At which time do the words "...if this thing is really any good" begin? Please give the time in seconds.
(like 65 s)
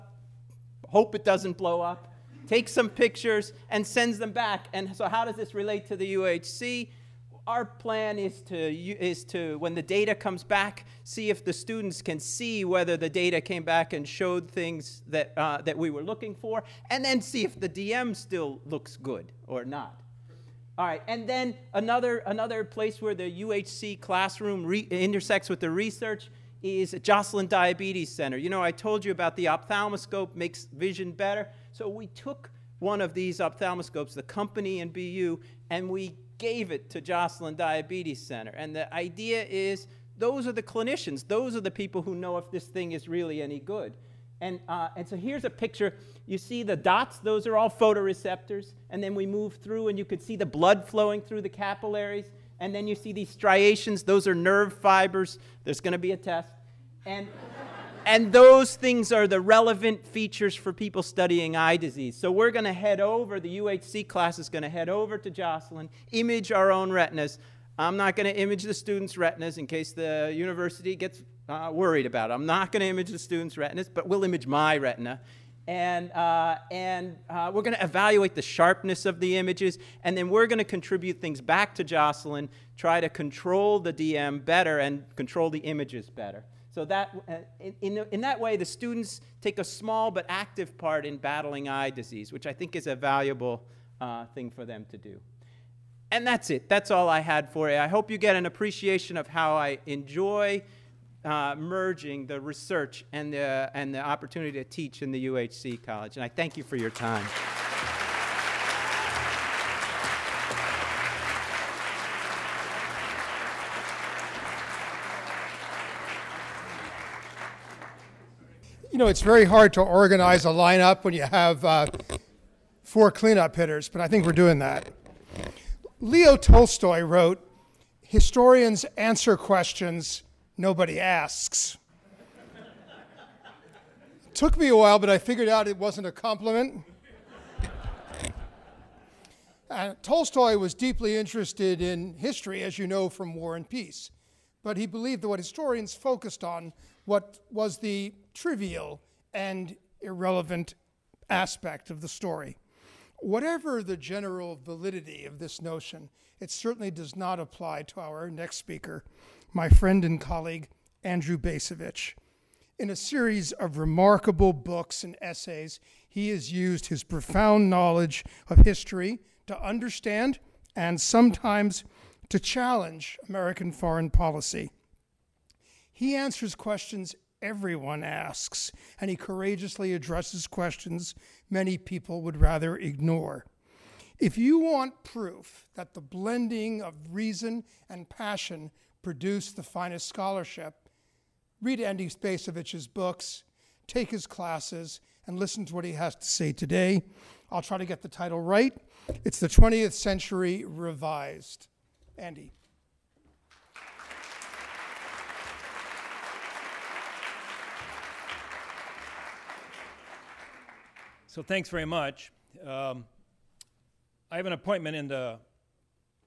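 42 s.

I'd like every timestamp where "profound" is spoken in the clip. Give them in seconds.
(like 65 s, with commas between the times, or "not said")
167 s.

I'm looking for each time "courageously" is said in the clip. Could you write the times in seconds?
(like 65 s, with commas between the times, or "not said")
179 s.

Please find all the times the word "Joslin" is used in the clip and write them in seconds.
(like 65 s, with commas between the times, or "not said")
27 s, 37 s, 65 s, 81 s.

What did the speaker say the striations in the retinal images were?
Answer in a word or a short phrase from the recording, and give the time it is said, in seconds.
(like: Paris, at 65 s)
Nerve fibers, at 54 s.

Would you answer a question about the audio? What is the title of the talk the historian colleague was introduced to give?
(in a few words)
The 20th Century Revised.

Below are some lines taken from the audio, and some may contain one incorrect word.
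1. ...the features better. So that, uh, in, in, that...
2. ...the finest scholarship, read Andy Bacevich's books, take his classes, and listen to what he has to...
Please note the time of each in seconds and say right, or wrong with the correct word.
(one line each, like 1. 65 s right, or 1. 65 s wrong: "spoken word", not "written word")
1. 85 s wrong: "images", not "features"
2. 189 s right.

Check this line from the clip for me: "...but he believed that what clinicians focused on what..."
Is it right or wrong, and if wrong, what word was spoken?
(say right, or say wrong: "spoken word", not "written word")
wrong: "historians", not "clinicians".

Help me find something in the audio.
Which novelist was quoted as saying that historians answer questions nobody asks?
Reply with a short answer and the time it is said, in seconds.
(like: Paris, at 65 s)
Leo Tolstoy, at 126 s.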